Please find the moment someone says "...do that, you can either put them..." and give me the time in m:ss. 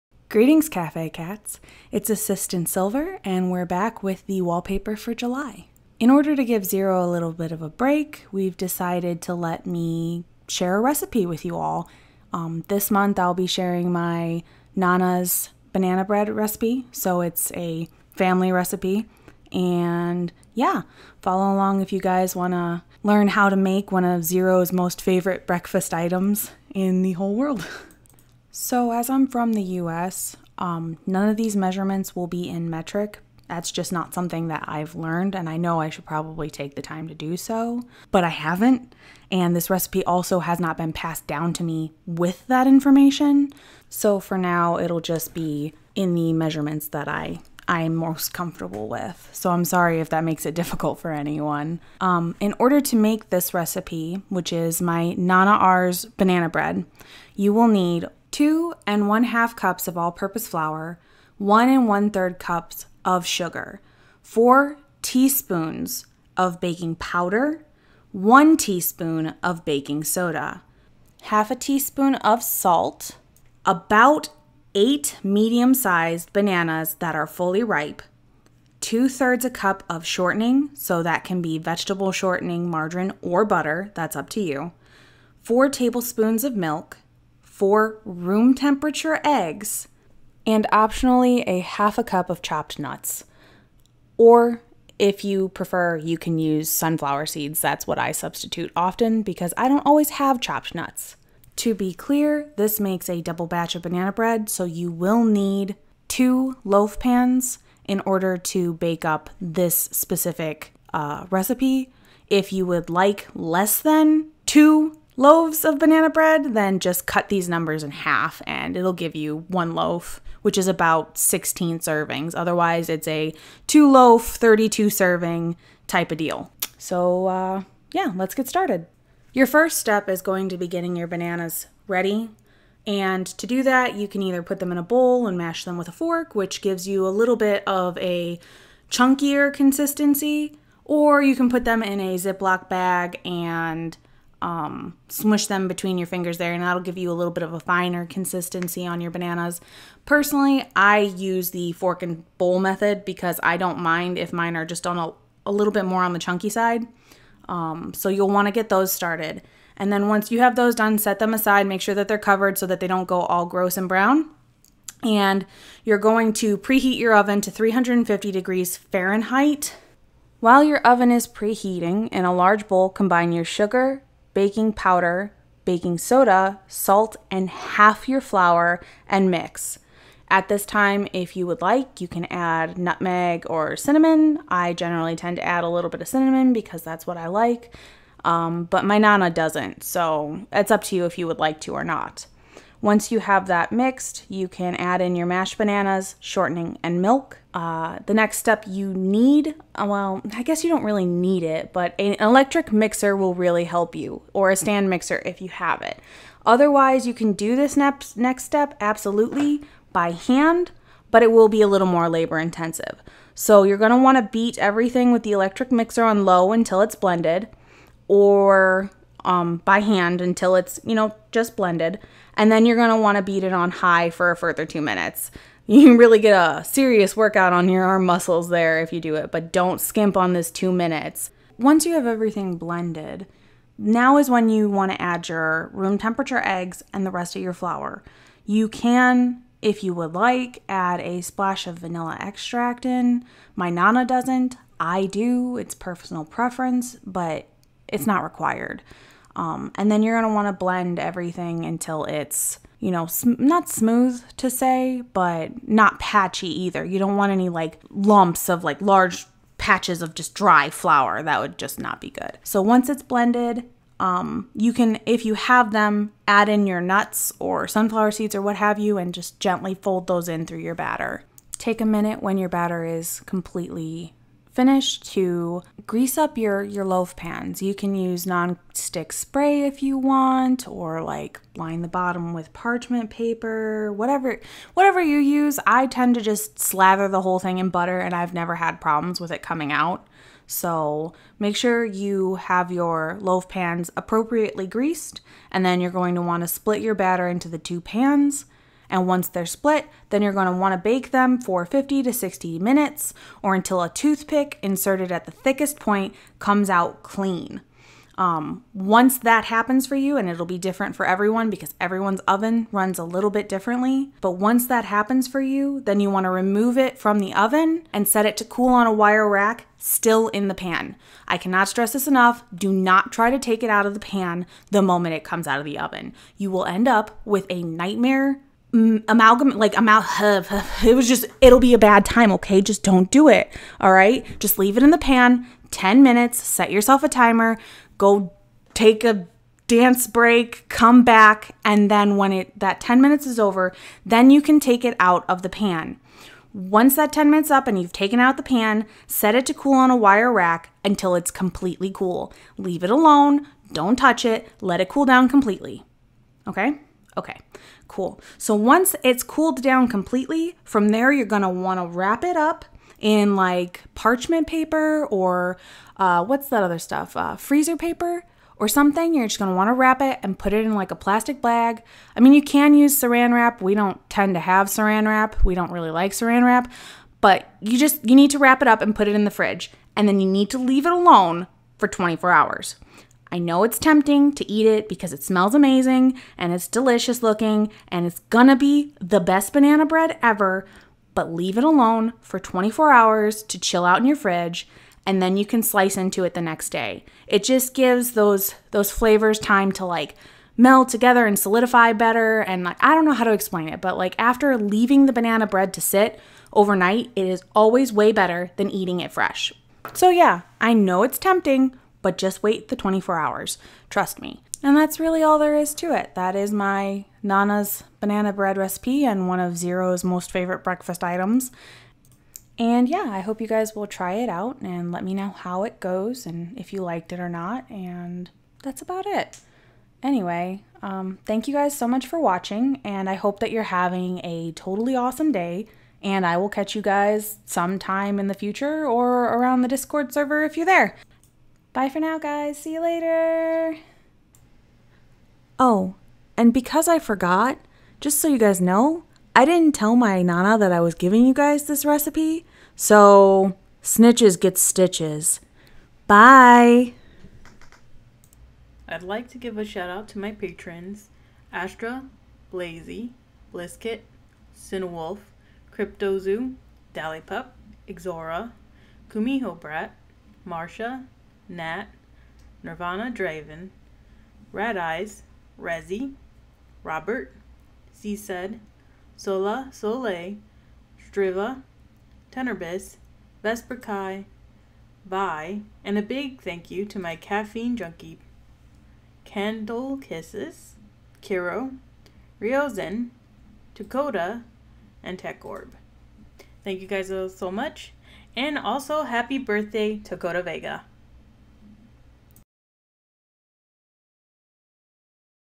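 2:13.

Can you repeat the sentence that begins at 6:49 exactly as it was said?
So yeah, I know it's tempting, but just wait the 24 hours.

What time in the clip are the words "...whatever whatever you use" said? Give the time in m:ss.
4:43.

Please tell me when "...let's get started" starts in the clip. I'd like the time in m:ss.
2:08.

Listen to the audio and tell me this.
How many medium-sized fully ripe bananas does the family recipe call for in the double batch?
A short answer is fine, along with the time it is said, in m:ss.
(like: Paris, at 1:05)
8, at 1:13.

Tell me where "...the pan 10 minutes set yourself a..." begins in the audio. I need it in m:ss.
5:34.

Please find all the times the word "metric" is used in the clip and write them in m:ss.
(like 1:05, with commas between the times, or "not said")
0:32.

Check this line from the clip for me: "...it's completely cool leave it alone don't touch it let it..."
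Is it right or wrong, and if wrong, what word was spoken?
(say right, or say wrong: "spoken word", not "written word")
right.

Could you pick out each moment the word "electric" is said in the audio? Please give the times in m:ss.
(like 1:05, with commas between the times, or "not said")
3:22, 3:35.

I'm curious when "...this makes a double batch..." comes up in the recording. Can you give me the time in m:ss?
1:42.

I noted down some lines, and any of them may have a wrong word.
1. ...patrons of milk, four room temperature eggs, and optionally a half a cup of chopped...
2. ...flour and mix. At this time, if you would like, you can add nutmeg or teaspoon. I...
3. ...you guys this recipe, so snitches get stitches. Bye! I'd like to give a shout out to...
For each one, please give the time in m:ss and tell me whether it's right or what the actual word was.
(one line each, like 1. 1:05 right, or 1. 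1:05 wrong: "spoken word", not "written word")
1. 1:25 wrong: "tablespoons", not "patrons"
2. 2:58 wrong: "cinnamon", not "teaspoon"
3. 7:31 right.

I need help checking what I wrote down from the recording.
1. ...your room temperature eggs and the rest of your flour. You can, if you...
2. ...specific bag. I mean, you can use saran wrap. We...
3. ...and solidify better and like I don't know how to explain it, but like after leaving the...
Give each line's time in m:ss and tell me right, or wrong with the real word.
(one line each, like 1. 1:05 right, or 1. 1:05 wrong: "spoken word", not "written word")
1. 3:55 right
2. 6:10 wrong: "plastic", not "specific"
3. 6:41 right.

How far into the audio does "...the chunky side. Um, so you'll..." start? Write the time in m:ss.
2:36.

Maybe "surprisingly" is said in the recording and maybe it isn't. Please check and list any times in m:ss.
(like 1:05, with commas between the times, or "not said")
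not said.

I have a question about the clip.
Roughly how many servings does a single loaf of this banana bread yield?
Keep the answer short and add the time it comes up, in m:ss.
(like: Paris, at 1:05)
16, at 2:00.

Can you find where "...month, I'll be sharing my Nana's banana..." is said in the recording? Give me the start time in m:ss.
0:12.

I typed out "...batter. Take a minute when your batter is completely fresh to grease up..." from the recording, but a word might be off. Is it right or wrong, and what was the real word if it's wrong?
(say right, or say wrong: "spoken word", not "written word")
wrong: "finish", not "fresh".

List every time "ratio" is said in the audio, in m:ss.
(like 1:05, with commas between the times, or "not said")
not said.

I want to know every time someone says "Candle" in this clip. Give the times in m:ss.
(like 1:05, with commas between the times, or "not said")
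8:09.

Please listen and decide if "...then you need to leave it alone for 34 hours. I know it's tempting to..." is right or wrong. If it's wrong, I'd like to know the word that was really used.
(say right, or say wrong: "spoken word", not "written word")
wrong: "24", not "34".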